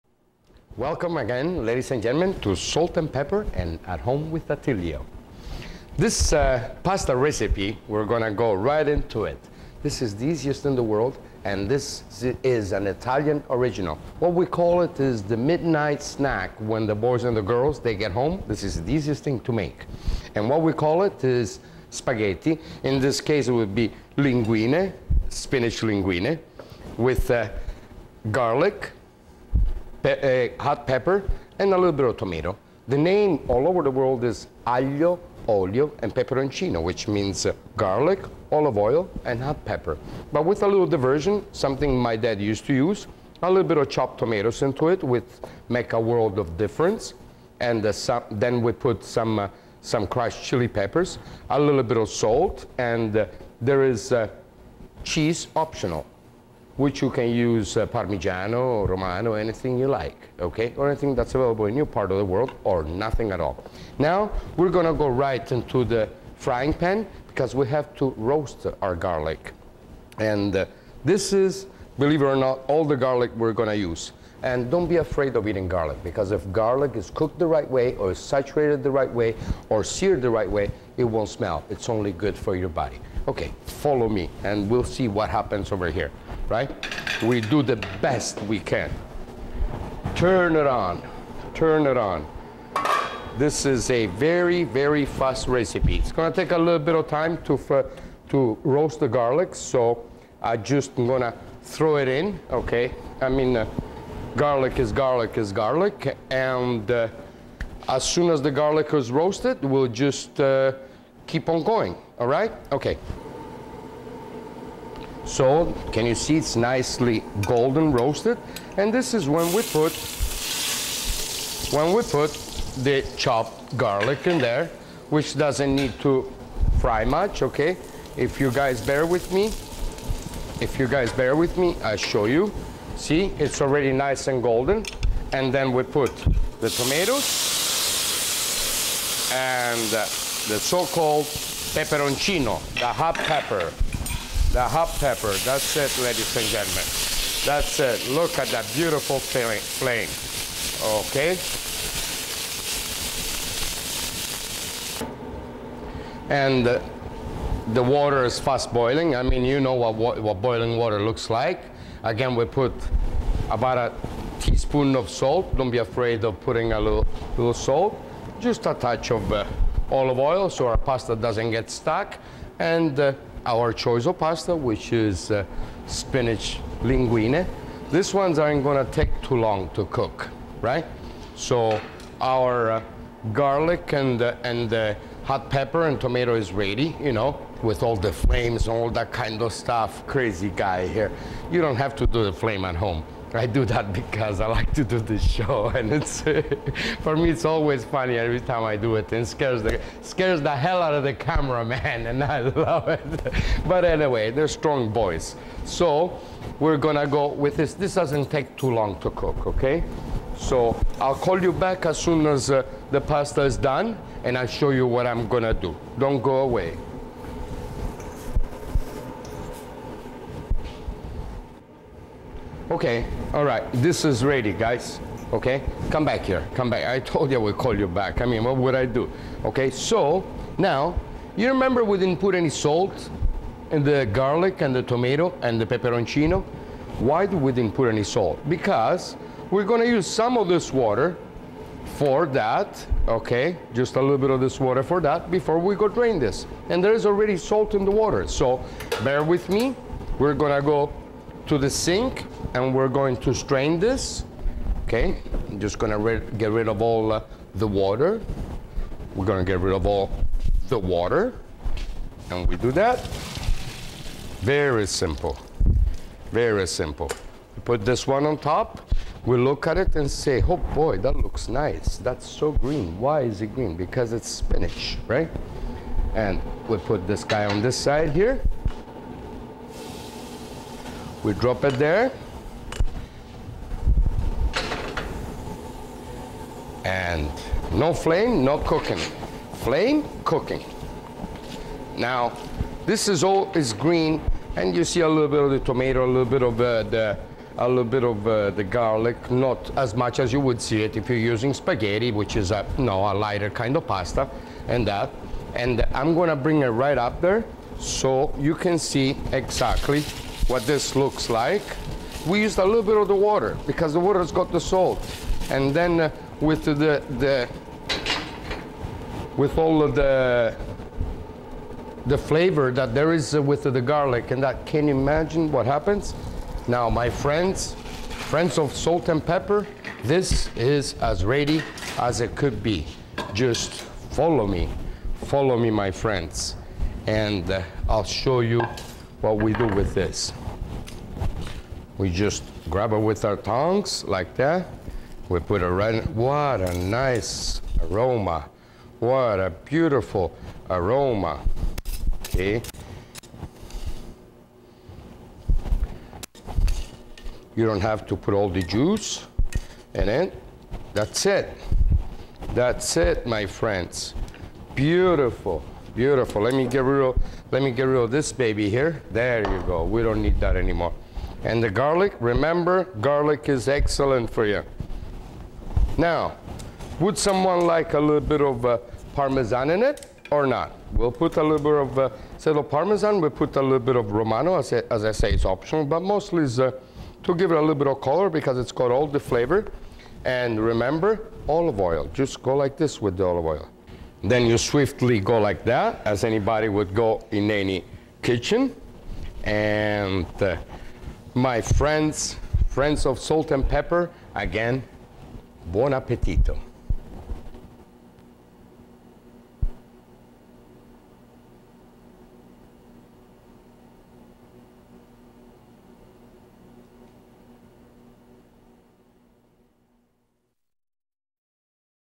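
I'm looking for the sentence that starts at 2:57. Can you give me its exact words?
These ones aren't gonna take too long to cook, right?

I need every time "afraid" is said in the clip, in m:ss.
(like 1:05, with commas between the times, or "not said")
1:14, 2:45.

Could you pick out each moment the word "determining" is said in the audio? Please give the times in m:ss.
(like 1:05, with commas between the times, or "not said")
not said.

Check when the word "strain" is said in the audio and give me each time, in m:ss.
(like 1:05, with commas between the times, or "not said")
4:13.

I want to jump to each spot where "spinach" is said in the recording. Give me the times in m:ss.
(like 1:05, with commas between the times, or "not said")
0:25, 2:55, 4:34.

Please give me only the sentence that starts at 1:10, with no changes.
And uh, this is, believe it or not, all the garlic we're gonna use.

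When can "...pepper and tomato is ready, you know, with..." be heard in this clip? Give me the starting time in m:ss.
3:05.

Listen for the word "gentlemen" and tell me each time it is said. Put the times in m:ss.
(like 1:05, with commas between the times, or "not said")
0:02, 2:26.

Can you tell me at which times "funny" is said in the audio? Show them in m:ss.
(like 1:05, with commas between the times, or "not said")
3:17.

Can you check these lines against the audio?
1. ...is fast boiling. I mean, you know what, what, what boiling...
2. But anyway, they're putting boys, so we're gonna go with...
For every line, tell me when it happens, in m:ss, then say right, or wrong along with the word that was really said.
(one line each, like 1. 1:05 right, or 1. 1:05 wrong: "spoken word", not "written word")
1. 2:38 right
2. 3:23 wrong: "strong", not "putting".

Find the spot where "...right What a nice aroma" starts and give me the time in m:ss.
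5:45.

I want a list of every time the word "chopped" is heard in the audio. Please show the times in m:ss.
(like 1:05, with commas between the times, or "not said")
0:43, 2:03.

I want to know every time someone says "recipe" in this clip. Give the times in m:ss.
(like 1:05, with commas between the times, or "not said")
0:07, 1:35.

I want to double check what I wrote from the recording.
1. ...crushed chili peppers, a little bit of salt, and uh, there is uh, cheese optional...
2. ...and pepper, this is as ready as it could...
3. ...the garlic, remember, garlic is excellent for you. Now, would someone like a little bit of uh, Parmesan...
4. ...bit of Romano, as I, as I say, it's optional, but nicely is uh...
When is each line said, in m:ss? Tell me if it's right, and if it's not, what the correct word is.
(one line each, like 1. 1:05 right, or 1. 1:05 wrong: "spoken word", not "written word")
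1. 0:50 right
2. 5:29 right
3. 6:11 right
4. 6:23 wrong: "mostly", not "nicely".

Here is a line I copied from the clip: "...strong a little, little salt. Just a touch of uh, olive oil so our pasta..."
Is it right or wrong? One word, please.
wrong.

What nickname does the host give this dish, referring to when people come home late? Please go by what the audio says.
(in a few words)
The midnight snack.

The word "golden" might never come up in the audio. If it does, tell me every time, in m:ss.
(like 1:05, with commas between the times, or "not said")
1:57, 2:14.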